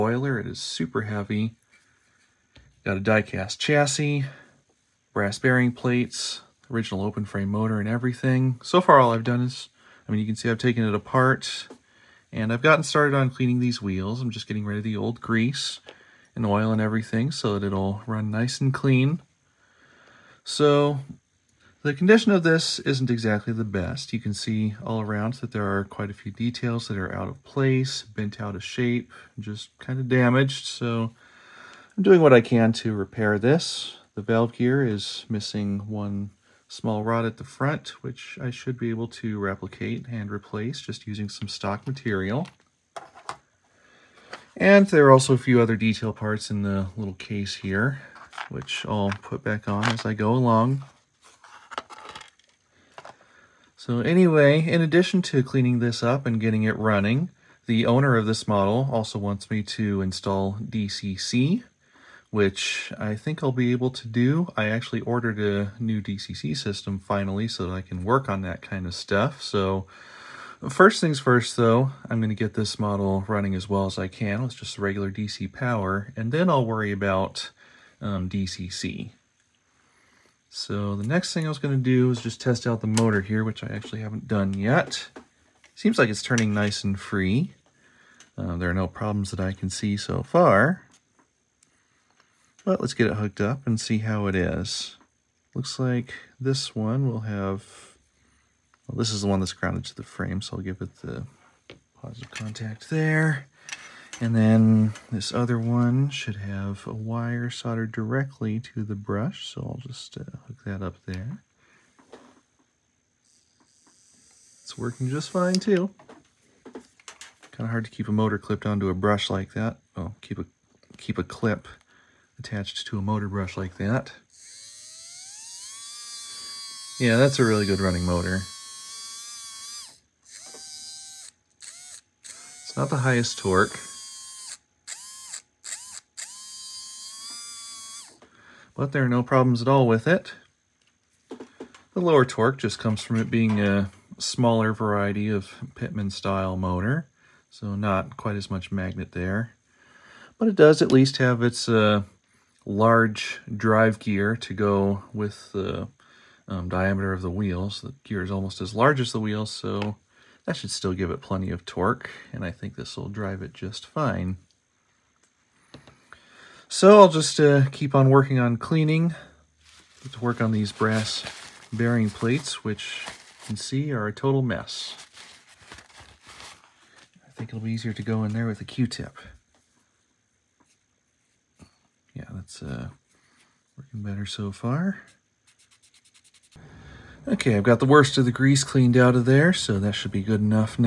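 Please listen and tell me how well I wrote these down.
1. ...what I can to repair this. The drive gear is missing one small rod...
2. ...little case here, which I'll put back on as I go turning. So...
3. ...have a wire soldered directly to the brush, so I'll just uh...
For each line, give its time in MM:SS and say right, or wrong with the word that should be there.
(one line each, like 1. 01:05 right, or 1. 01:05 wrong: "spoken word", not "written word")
1. 00:32 wrong: "valve", not "drive"
2. 00:46 wrong: "along", not "turning"
3. 01:46 right.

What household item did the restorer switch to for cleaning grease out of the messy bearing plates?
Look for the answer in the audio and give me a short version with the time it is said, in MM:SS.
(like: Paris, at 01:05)
Q-tip, at 02:58.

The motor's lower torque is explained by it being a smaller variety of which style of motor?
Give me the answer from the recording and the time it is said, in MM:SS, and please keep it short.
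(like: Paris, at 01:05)
Pittman, at 02:25.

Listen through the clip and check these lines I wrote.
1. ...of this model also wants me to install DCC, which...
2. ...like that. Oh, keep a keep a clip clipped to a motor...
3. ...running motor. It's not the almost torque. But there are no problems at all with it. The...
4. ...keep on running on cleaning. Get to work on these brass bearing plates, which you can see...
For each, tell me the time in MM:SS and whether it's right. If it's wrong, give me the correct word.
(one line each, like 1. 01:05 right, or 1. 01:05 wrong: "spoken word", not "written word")
1. 00:58 right
2. 01:59 wrong: "attached", not "clipped"
3. 02:07 wrong: "highest", not "almost"
4. 02:47 wrong: "working", not "running".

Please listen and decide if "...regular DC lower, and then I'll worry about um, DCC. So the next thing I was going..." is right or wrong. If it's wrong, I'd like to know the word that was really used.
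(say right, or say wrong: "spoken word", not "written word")
wrong: "power", not "lower".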